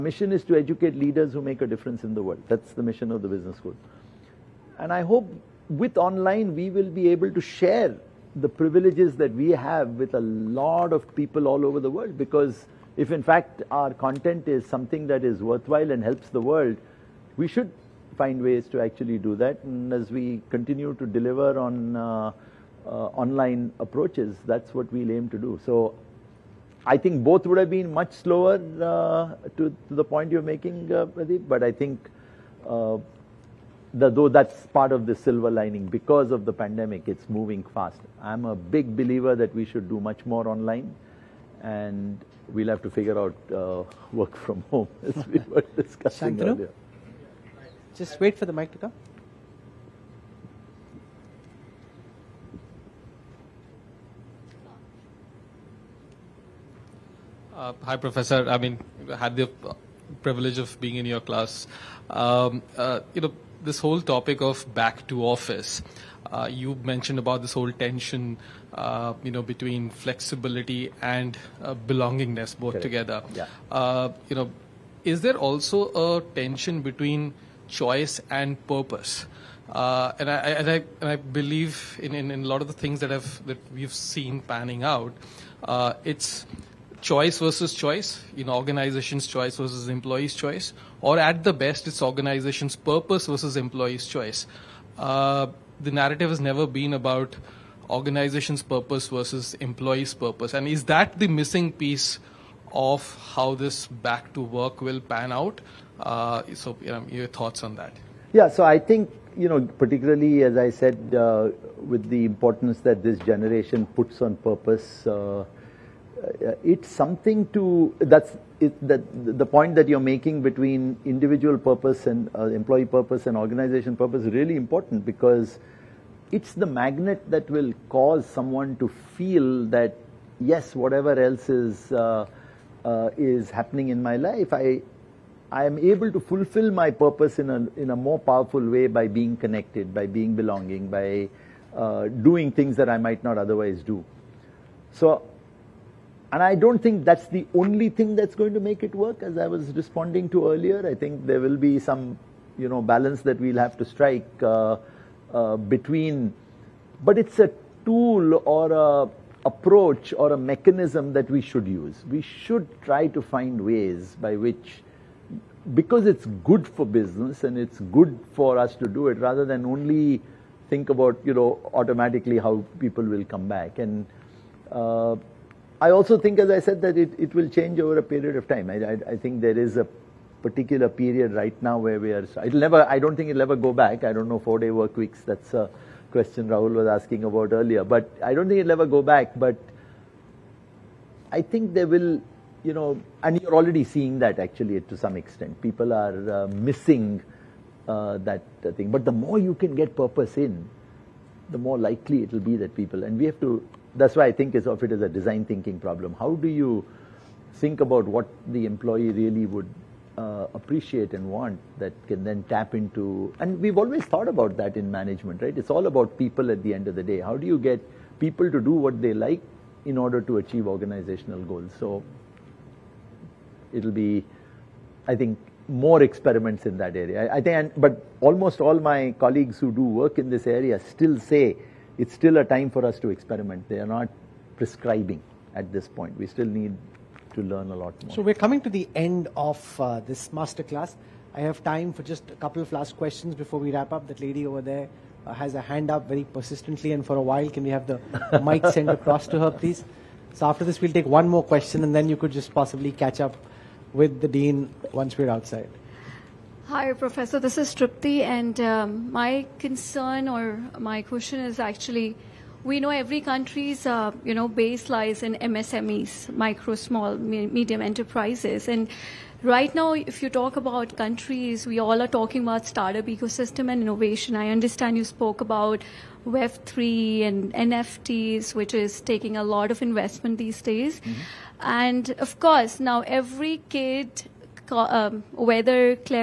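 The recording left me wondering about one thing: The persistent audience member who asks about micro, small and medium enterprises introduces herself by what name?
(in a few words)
Tripti.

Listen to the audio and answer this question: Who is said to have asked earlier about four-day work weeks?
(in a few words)
Rahul.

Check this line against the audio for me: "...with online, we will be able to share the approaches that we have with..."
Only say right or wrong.
wrong.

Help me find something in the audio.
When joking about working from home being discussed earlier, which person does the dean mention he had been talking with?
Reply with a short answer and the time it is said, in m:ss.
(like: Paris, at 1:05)
Shantanu, at 0:46.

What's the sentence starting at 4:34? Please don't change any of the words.
I understand you spoke about Web3 and NFTs, which is taking a lot of investment these days, mm -hmm.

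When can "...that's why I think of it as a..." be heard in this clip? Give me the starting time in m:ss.
3:23.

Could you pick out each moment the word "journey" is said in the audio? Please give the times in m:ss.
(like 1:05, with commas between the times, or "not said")
not said.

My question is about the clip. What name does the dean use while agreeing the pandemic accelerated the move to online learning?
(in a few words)
Pradeep.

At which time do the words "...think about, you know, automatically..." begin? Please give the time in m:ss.
2:50.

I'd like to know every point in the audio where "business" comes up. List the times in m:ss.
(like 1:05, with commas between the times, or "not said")
0:03, 2:46.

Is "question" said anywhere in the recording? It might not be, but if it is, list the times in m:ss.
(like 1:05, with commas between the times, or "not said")
3:06, 4:02, 4:11, 4:21.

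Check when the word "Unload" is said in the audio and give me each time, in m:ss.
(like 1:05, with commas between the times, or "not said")
not said.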